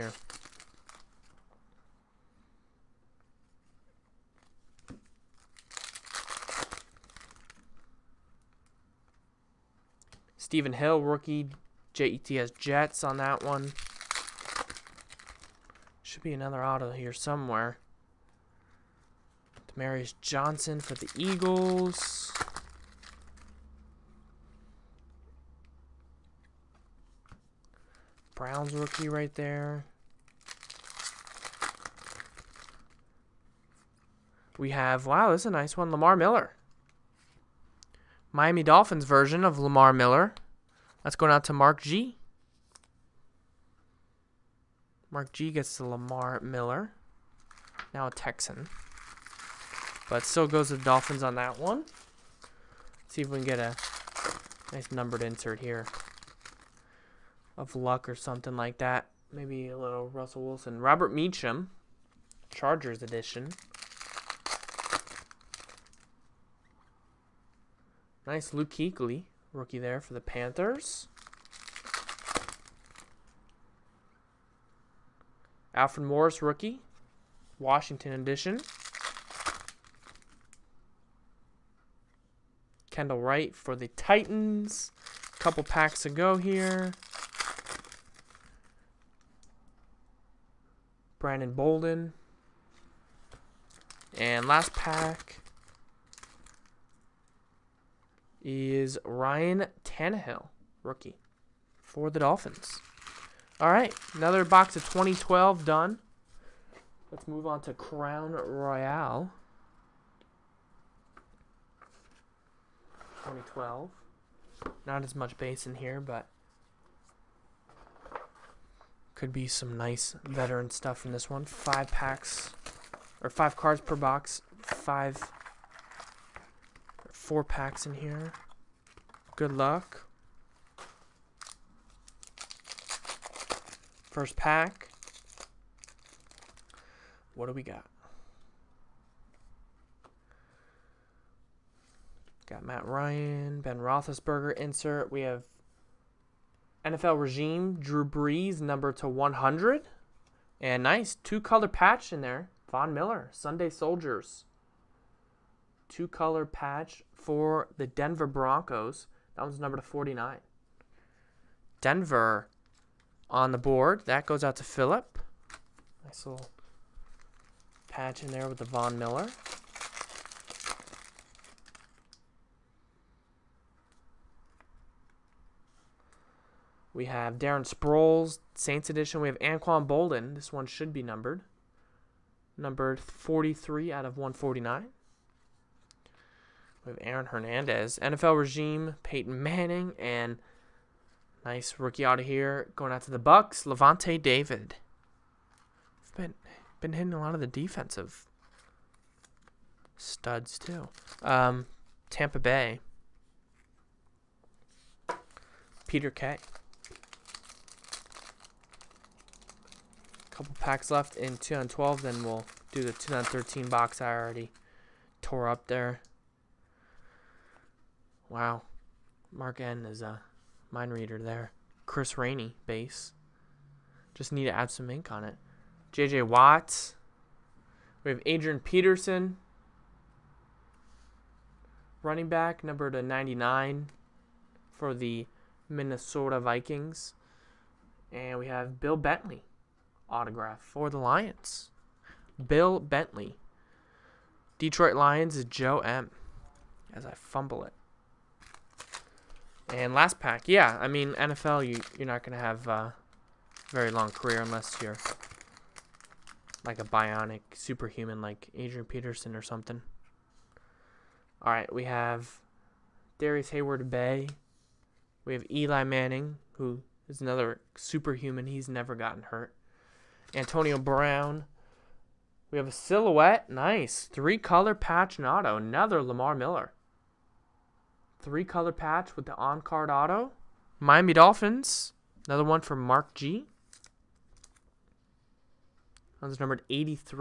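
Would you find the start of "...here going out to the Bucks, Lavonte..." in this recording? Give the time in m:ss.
3:12.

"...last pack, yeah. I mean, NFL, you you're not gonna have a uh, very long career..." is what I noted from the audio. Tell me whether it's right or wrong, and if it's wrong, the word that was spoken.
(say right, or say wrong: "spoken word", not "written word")
right.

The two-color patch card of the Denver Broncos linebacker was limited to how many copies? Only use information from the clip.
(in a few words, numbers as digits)
49.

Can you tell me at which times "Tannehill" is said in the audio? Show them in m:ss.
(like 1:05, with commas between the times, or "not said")
1:39.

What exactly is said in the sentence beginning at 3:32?
Then we'll do the 2013 box I already tore up there.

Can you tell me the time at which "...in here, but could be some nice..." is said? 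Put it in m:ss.
1:55.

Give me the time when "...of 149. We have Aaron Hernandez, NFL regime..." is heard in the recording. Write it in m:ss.
3:04.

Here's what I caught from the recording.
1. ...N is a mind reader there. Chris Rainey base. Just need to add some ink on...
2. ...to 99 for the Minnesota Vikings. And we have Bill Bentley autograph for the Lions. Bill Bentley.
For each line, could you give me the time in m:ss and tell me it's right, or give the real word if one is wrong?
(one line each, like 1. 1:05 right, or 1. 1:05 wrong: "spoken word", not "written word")
1. 3:39 right
2. 3:52 right.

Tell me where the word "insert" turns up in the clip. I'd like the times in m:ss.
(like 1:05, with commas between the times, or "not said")
0:55, 2:24.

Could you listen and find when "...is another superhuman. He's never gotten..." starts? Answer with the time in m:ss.
4:27.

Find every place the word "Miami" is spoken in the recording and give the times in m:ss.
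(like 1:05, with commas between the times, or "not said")
0:38, 4:40.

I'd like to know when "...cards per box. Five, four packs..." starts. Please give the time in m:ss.
2:03.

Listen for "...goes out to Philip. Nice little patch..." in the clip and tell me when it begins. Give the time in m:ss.
2:44.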